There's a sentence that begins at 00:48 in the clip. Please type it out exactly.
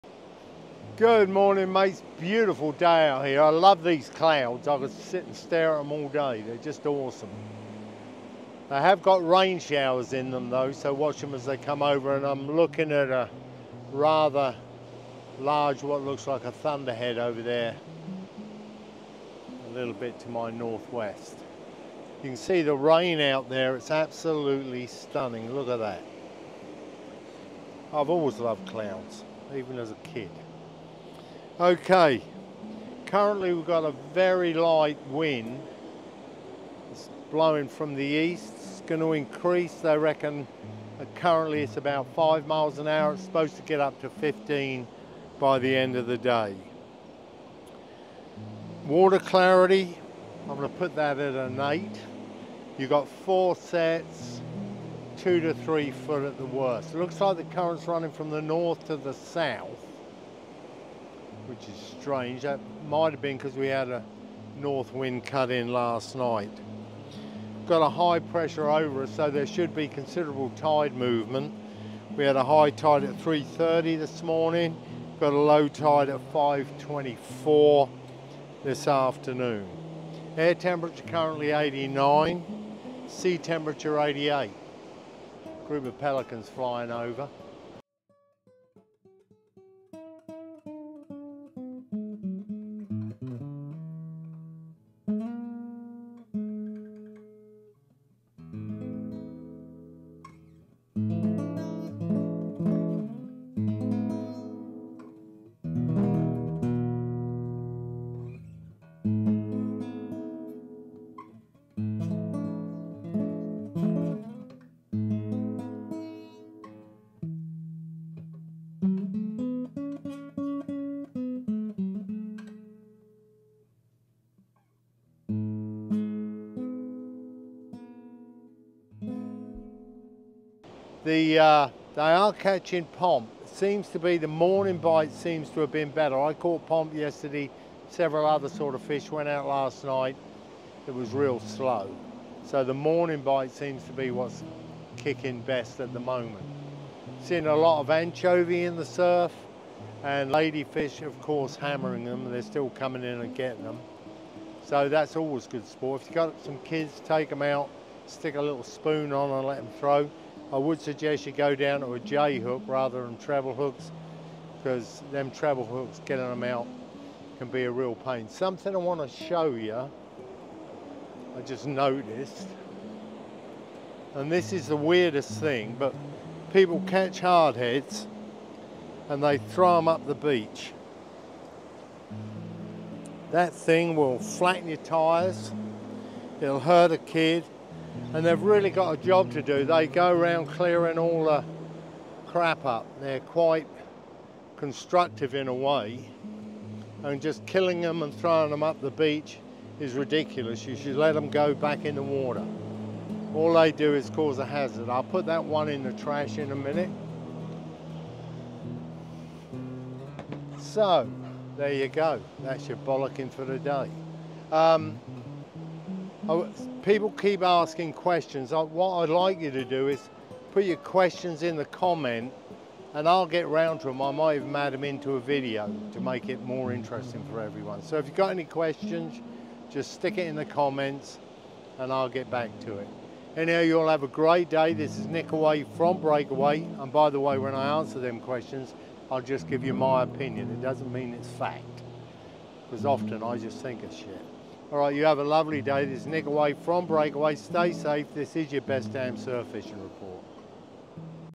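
Water clarity, I'm going to put that at an eight.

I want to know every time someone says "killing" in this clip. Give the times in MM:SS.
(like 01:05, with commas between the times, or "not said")
03:17.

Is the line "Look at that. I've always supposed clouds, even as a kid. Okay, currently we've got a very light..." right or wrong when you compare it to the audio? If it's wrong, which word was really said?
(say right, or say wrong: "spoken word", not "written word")
wrong: "loved", not "supposed".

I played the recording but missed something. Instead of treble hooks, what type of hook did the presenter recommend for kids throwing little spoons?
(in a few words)
J hook.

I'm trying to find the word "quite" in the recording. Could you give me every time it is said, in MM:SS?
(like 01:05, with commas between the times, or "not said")
03:13.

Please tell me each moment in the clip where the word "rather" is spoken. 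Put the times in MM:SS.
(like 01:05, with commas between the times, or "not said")
00:13, 02:42.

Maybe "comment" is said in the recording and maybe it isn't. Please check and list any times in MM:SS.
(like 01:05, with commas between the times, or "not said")
03:41, 03:50.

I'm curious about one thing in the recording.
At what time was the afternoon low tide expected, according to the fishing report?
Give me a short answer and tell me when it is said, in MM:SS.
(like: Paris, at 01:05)
5:24, at 01:16.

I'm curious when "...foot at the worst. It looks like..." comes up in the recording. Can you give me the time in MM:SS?
00:55.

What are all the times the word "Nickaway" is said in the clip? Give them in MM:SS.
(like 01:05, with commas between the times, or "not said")
03:55, 04:06.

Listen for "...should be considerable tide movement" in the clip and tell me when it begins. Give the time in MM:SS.
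01:09.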